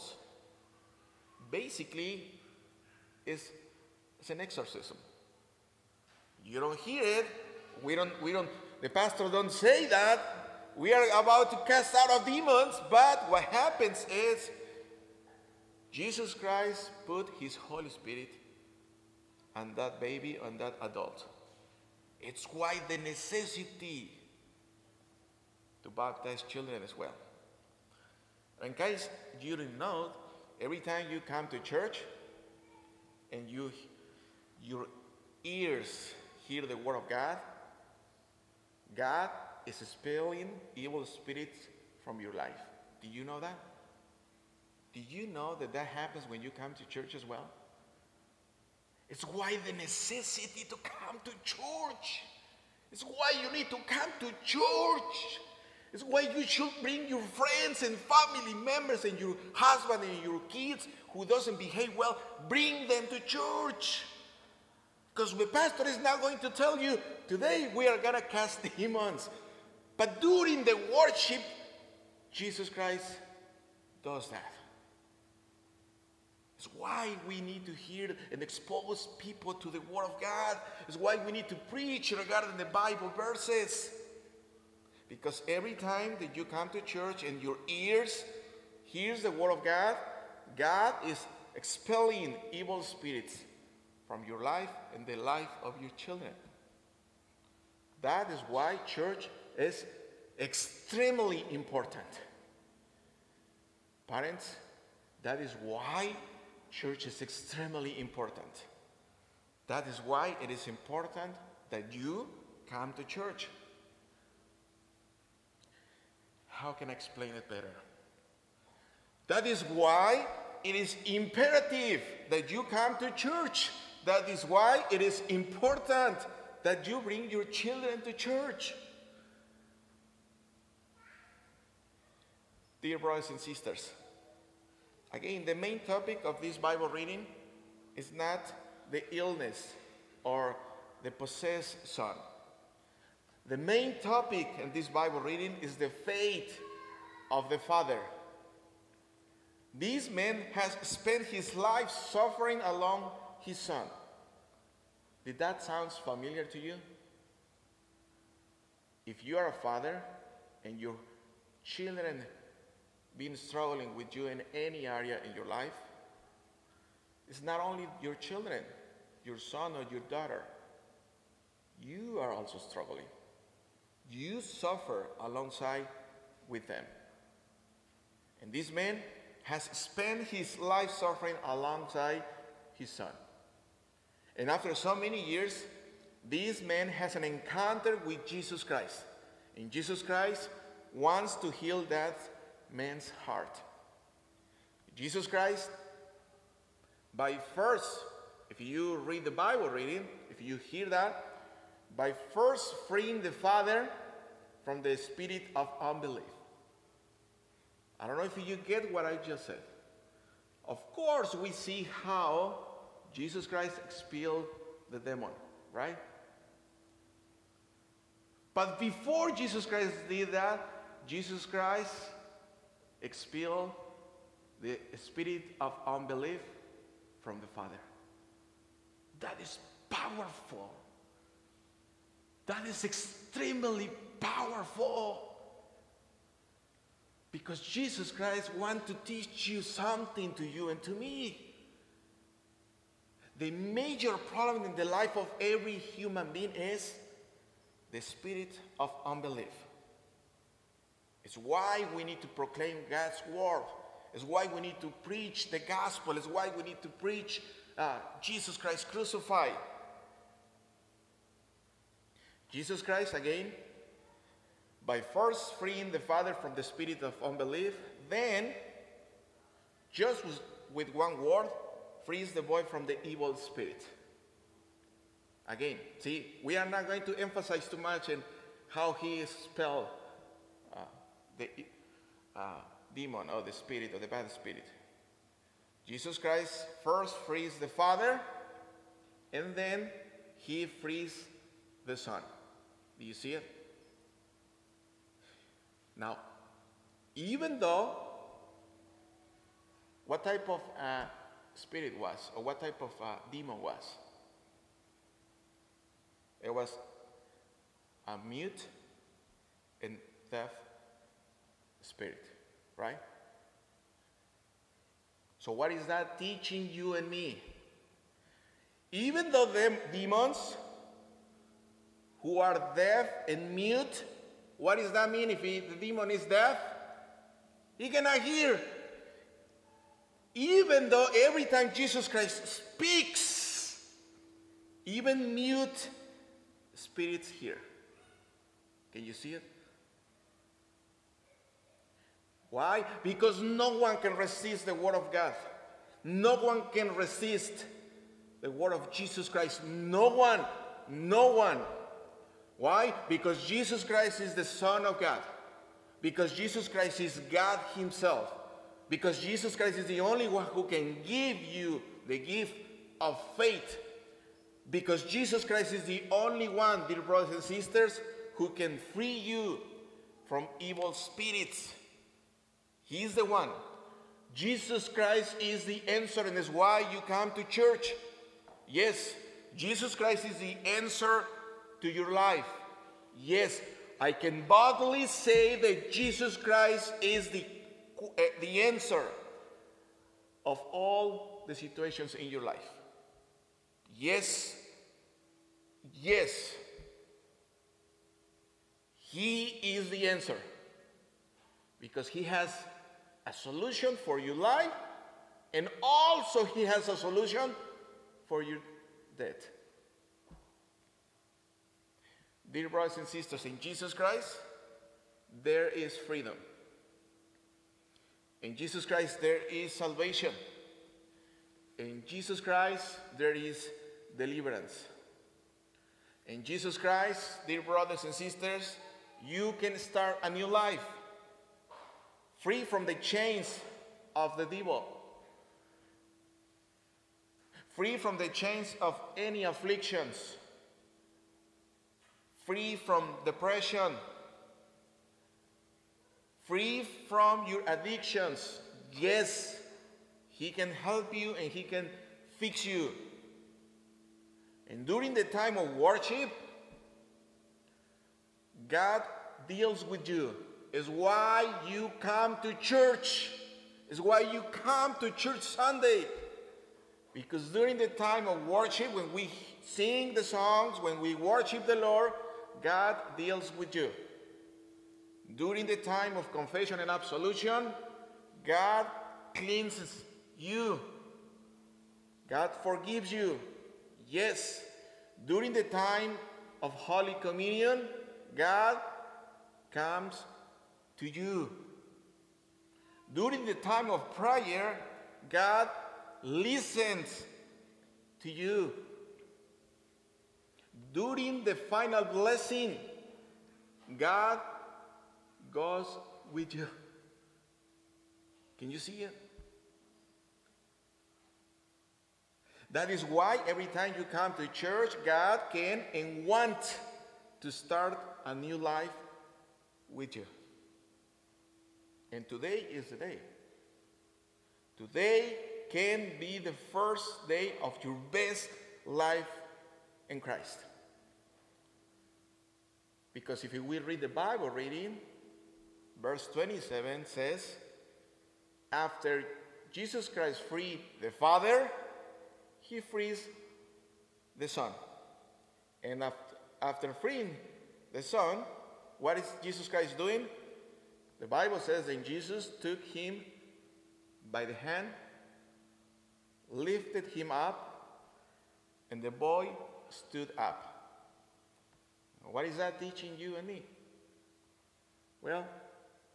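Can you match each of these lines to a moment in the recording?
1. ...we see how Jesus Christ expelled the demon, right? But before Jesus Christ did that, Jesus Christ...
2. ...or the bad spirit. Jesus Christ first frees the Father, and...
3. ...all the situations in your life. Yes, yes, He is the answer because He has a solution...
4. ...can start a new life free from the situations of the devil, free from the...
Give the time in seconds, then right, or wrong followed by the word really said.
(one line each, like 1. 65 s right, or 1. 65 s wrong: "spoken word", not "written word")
1. 211 s right
2. 283 s right
3. 390 s right
4. 429 s wrong: "chains", not "situations".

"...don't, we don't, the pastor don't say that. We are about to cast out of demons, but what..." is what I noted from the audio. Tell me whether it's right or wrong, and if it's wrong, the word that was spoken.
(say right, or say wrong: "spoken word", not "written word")
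right.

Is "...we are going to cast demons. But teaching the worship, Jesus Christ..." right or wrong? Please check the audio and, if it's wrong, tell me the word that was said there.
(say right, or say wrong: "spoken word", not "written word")
wrong: "during", not "teaching".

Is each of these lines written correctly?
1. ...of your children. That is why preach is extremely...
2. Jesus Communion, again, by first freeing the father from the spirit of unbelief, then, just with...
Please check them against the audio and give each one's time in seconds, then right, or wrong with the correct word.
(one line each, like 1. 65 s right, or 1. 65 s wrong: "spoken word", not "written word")
1. 95 s wrong: "church", not "preach"
2. 262 s wrong: "Christ", not "Communion".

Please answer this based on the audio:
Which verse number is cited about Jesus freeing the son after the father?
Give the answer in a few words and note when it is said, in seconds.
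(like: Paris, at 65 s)
27, at 536 s.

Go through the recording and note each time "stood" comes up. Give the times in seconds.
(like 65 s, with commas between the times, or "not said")
559 s.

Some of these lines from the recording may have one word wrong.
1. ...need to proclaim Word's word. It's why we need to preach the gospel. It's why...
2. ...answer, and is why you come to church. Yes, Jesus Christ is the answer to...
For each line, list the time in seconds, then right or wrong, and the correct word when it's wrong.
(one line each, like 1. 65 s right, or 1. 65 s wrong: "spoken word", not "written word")
1. 252 s wrong: "God", not "Word"
2. 375 s right.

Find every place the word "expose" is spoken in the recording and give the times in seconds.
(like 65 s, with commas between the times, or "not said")
78 s.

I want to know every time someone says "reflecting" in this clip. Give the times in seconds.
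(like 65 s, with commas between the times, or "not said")
not said.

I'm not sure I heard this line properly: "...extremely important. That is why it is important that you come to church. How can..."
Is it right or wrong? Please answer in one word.
right.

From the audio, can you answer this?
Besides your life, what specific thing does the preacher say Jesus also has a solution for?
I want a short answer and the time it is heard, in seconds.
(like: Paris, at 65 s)
your debt, at 408 s.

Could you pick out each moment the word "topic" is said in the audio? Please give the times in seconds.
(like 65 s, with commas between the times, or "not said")
135 s, 144 s.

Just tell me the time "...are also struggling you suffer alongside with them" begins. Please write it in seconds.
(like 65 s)
172 s.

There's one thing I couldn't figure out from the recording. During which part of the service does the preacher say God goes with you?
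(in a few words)
the final blessing.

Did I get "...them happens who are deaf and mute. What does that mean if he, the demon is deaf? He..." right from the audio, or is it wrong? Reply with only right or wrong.
wrong.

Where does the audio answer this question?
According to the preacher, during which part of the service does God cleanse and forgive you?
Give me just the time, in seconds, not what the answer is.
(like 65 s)
476 s.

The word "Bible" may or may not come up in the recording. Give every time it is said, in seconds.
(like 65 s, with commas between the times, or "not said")
82 s, 136 s, 144 s, 199 s, 534 s, 551 s.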